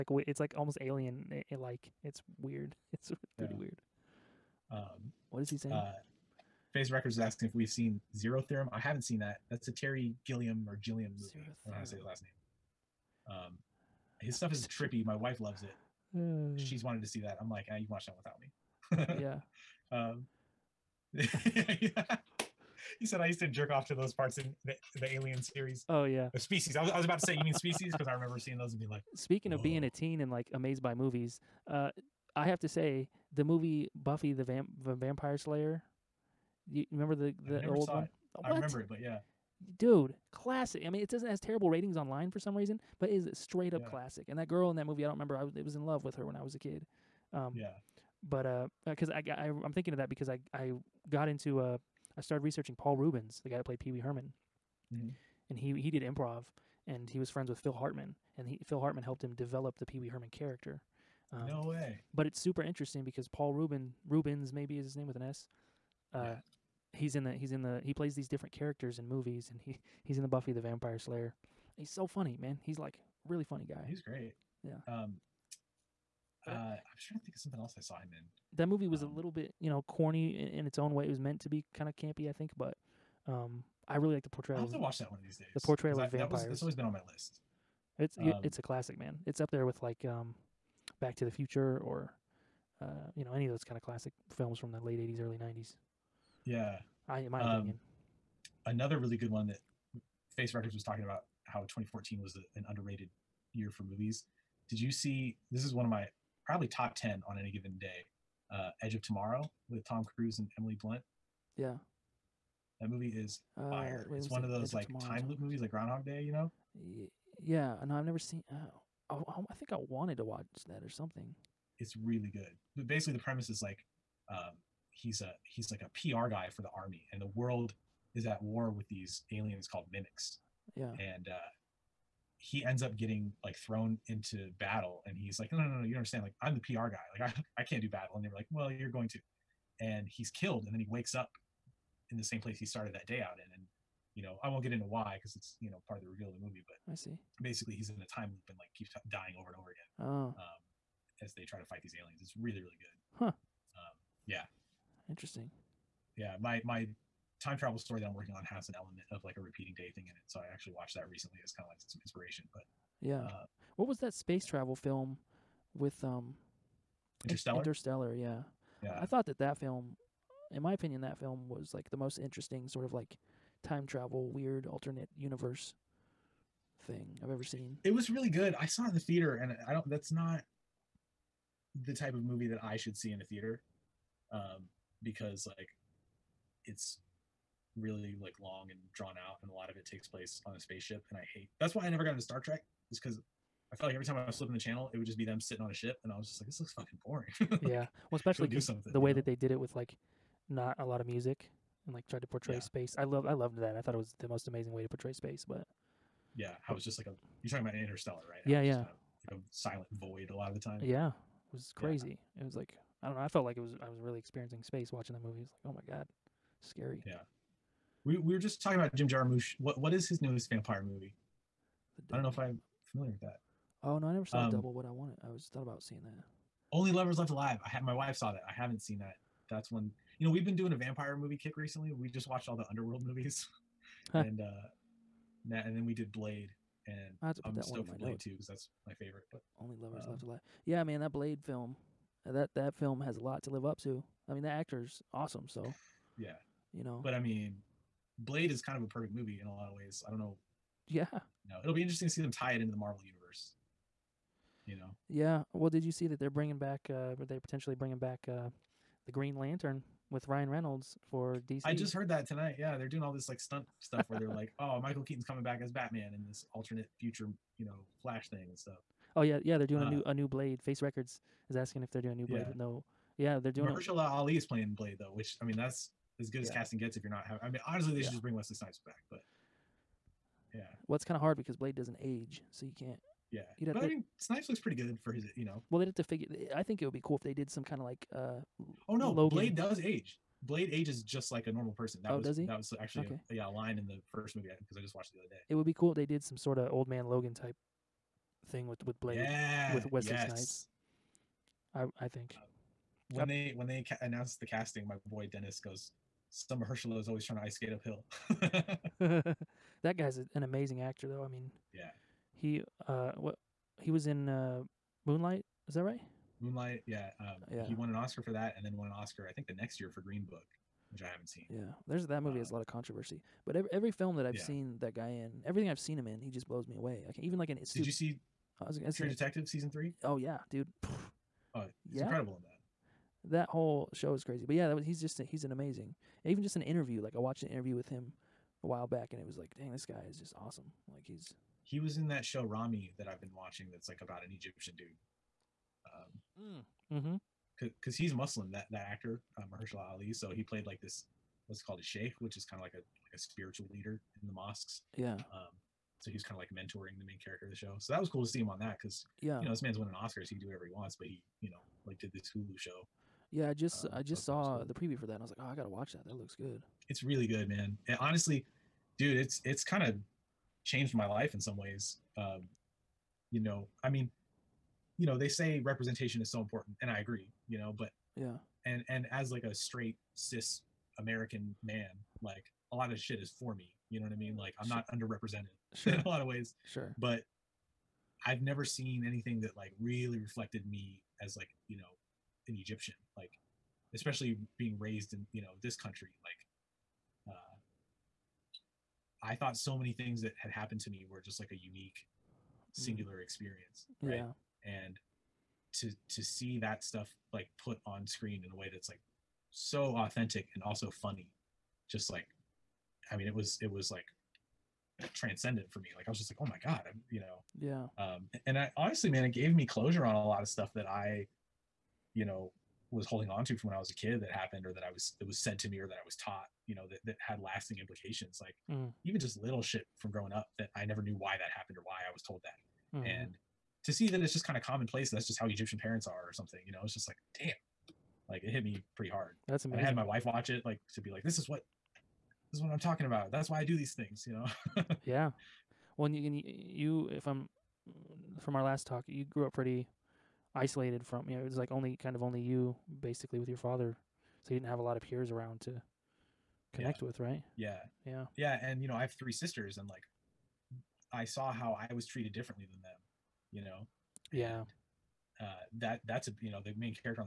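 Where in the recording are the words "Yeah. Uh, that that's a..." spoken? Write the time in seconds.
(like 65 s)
464 s.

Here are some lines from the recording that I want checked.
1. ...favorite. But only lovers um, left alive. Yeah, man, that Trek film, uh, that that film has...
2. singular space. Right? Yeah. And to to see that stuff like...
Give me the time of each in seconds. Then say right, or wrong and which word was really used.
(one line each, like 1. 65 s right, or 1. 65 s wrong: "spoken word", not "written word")
1. 238 s wrong: "Blade", not "Trek"
2. 402 s wrong: "experience", not "space".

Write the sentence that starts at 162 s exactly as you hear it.
But yeah, uh, what was that space yeah.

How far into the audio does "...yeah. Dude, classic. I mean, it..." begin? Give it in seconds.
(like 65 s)
38 s.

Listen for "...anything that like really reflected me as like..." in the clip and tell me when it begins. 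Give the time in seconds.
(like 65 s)
389 s.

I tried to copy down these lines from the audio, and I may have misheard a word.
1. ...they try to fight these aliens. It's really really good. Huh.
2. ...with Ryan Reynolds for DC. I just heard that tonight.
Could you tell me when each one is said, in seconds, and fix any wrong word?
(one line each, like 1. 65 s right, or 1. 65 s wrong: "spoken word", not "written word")
1. 151 s right
2. 260 s right.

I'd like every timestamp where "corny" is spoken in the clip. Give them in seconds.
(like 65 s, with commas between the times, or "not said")
79 s.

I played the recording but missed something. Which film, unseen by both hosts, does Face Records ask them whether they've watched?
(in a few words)
Zero Theorem.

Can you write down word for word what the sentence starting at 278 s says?
should just bring Wesley Snipes back, but.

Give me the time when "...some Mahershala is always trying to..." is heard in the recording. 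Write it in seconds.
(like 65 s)
306 s.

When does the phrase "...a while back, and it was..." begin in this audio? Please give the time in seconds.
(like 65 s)
338 s.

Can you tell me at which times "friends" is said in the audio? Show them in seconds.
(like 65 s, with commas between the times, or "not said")
57 s.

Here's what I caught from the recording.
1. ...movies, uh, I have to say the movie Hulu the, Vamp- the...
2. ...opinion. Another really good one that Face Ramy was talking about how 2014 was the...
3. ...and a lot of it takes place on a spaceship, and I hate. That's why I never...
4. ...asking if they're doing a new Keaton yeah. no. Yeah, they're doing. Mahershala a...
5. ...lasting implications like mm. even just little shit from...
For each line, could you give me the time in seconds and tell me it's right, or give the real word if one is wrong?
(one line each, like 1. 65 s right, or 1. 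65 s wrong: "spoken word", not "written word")
1. 30 s wrong: "Buffy", not "Hulu"
2. 97 s wrong: "Records", not "Ramy"
3. 189 s right
4. 271 s wrong: "Blade", not "Keaton"
5. 427 s right.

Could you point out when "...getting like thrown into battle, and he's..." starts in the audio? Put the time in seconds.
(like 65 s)
132 s.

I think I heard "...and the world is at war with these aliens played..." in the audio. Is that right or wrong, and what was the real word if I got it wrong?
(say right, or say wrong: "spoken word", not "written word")
wrong: "called", not "played".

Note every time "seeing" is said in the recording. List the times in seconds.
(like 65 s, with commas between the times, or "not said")
28 s, 225 s.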